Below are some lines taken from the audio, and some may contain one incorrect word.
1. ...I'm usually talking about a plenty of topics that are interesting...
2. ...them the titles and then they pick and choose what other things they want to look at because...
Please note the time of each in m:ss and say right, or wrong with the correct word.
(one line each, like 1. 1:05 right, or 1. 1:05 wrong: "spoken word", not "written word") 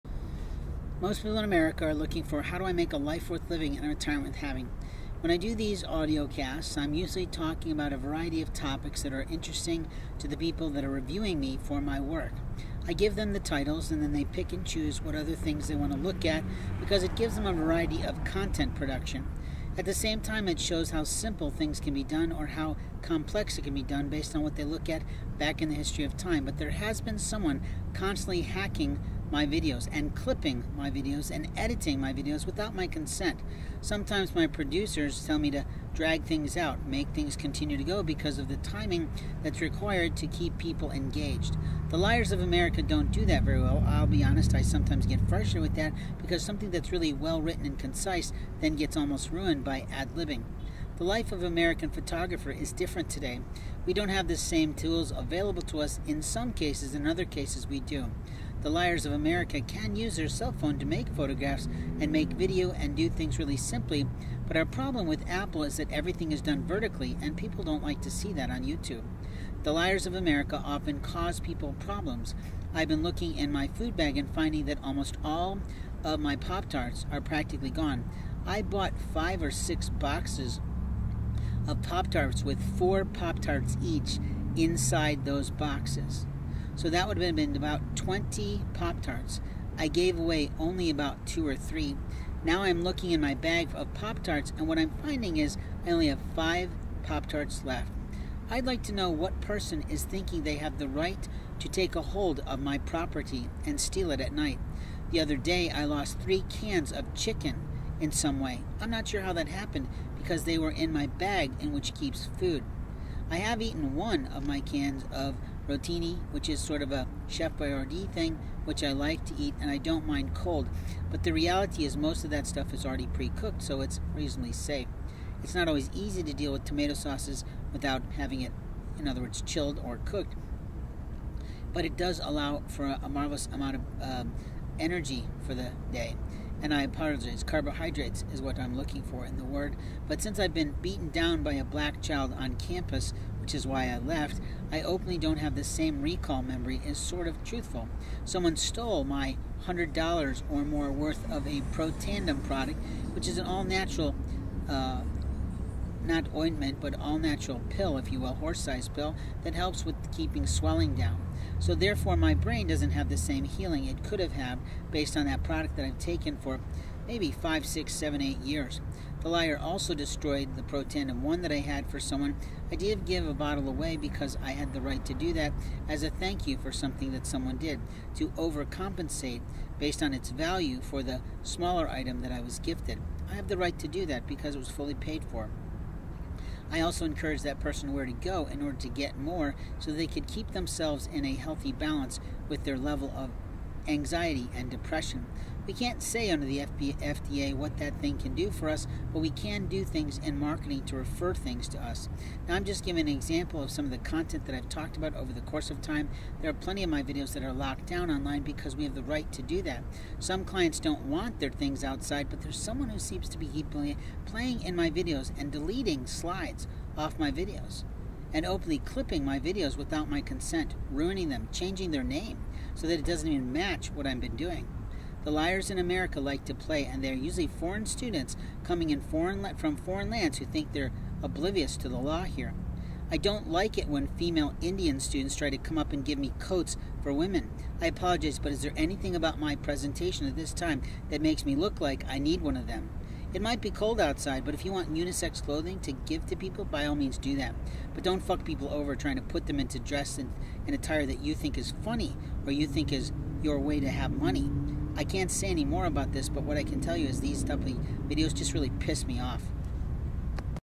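1. 0:06 wrong: "variety", not "plenty"
2. 0:13 right.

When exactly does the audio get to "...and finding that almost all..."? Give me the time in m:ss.
1:14.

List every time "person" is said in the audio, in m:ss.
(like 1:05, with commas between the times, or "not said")
1:39, 3:07.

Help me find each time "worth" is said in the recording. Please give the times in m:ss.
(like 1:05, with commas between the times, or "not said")
0:03, 2:30.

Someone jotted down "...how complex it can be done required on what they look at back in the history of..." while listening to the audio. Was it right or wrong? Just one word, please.
wrong.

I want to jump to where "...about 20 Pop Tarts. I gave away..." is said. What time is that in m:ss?
1:27.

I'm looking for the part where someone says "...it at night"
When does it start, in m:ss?
1:44.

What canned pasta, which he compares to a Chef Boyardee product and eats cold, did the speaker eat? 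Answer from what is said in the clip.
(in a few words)
rotini.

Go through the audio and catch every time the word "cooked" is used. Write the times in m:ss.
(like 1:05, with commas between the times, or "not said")
2:03, 2:09.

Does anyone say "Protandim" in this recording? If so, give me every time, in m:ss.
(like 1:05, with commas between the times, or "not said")
2:31, 2:50.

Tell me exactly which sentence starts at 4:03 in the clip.
It might be cold outside, but if you want unisex clothing to give to people, by all means do that.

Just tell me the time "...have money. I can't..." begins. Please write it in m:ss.
4:13.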